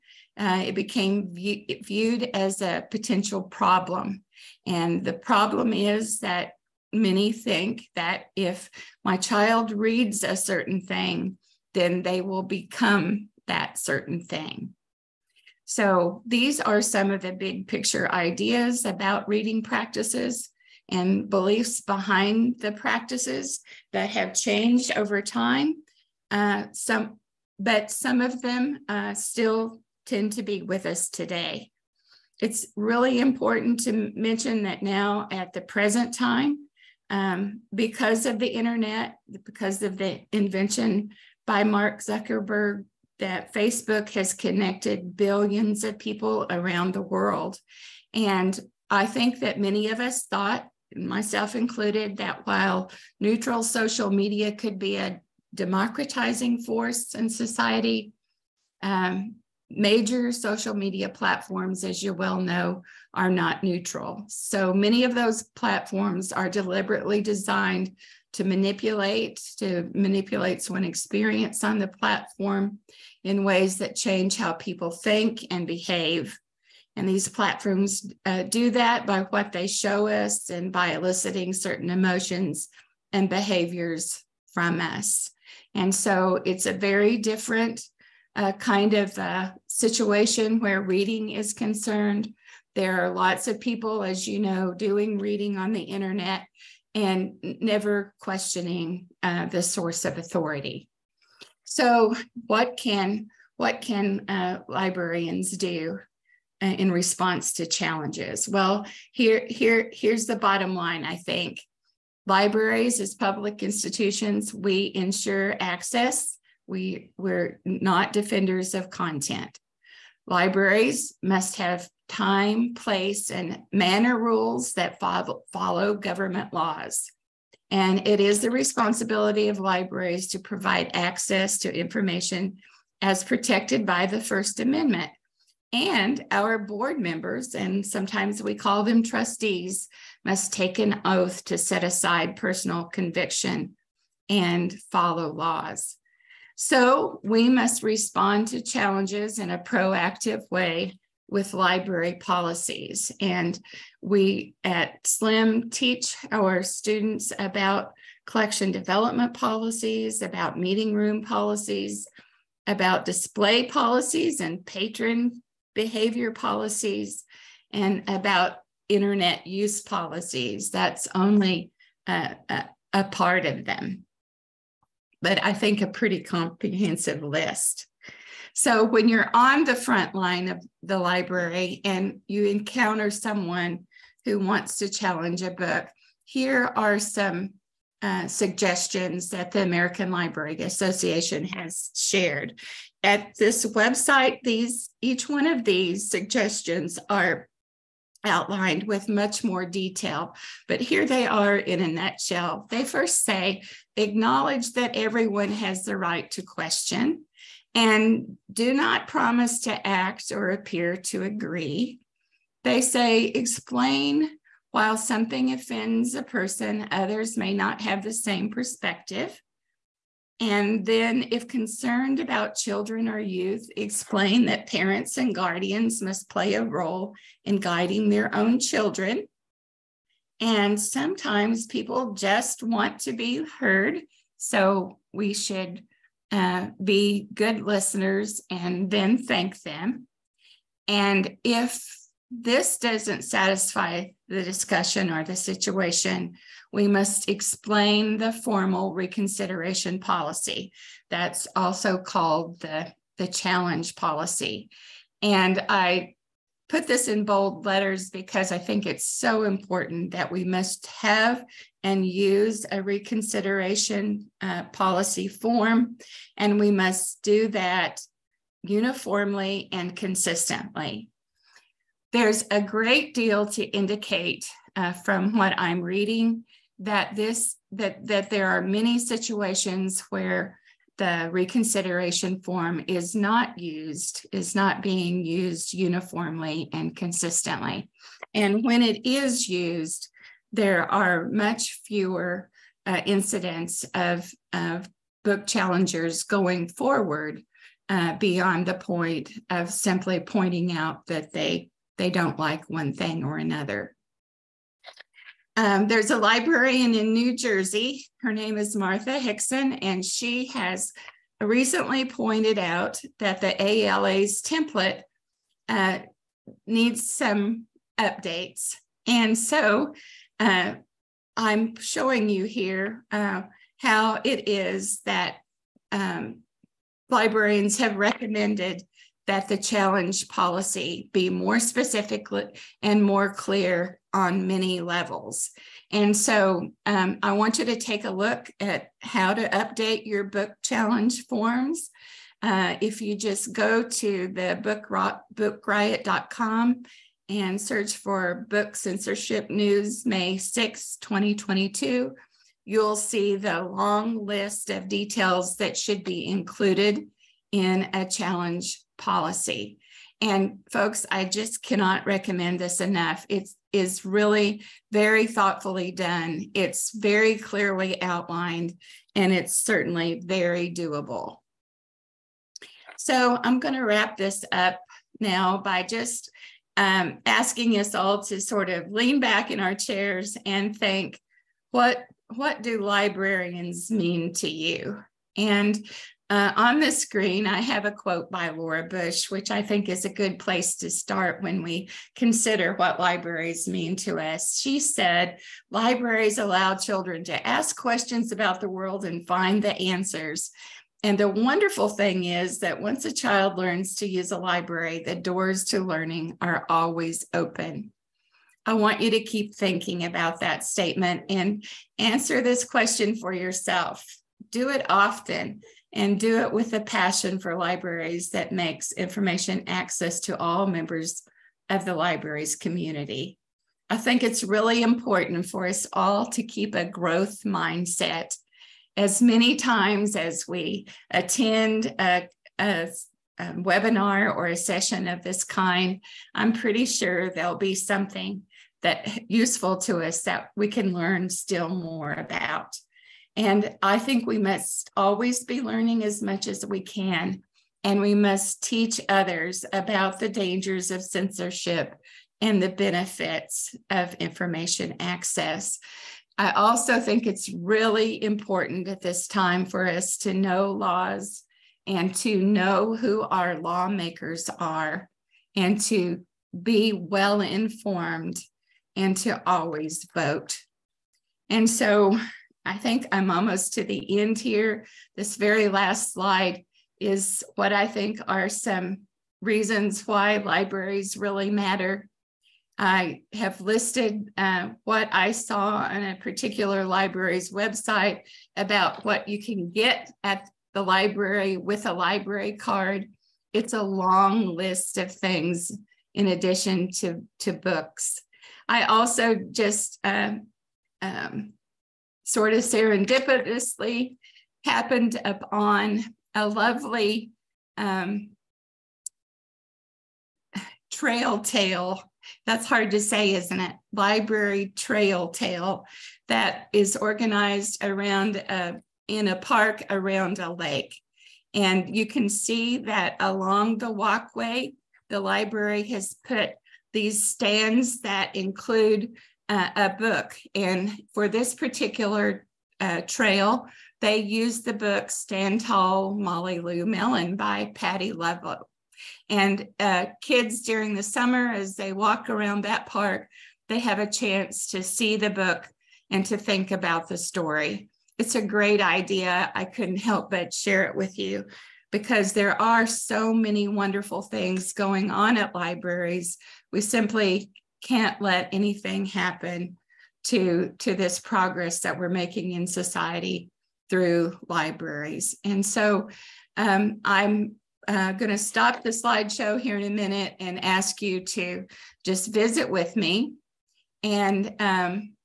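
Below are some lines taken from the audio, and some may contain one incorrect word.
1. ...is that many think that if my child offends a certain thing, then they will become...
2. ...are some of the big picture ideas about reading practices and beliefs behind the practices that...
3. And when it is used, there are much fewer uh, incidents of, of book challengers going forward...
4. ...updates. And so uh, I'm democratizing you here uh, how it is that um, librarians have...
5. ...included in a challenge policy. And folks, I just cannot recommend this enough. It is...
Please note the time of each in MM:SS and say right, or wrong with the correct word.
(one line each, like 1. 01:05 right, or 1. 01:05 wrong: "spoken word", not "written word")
1. 00:05 wrong: "reads", not "offends"
2. 00:16 right
3. 04:48 right
4. 05:17 wrong: "showing", not "democratizing"
5. 05:56 right.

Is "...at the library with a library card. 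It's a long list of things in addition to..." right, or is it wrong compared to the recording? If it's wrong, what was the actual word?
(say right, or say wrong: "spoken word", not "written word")
right.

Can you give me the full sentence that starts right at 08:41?
And you can see that along the walkway, the library has put these stands that include uh, a book.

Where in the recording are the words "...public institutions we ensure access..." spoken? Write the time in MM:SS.
01:53.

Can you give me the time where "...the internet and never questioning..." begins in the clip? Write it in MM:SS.
01:35.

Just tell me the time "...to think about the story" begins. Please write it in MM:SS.
09:06.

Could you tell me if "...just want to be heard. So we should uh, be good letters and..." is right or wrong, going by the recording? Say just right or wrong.
wrong.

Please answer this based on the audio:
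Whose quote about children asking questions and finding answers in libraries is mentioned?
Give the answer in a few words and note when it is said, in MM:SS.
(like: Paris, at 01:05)
Laura Bush, at 06:28.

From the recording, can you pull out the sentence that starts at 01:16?
And these platforms uh, do that by what they show us and by eliciting certain emotions and behaviors from us.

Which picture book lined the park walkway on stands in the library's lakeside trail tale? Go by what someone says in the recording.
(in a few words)
Stand Tall, Molly Lou Melon.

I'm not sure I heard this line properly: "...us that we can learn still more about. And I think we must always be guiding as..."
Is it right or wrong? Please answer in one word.
wrong.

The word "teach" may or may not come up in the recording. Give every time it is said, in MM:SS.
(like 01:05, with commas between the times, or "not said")
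02:35, 07:28.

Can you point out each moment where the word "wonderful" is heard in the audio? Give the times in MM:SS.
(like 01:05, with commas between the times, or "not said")
06:41, 09:13.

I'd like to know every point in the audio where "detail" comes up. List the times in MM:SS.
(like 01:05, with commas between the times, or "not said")
03:19, 05:54.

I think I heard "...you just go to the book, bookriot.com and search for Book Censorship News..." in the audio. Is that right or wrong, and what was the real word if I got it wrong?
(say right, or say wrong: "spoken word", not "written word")
right.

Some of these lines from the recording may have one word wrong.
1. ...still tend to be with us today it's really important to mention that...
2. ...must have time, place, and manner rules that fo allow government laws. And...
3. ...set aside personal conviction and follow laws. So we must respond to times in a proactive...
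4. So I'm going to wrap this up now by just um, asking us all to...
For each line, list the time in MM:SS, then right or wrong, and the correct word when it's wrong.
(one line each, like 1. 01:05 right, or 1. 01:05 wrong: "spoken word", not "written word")
1. 00:29 right
2. 02:01 wrong: "follow", not "allow"
3. 02:21 wrong: "challenges", not "times"
4. 06:12 right.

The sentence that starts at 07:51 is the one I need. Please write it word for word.
And so I think I'm almost to the end here.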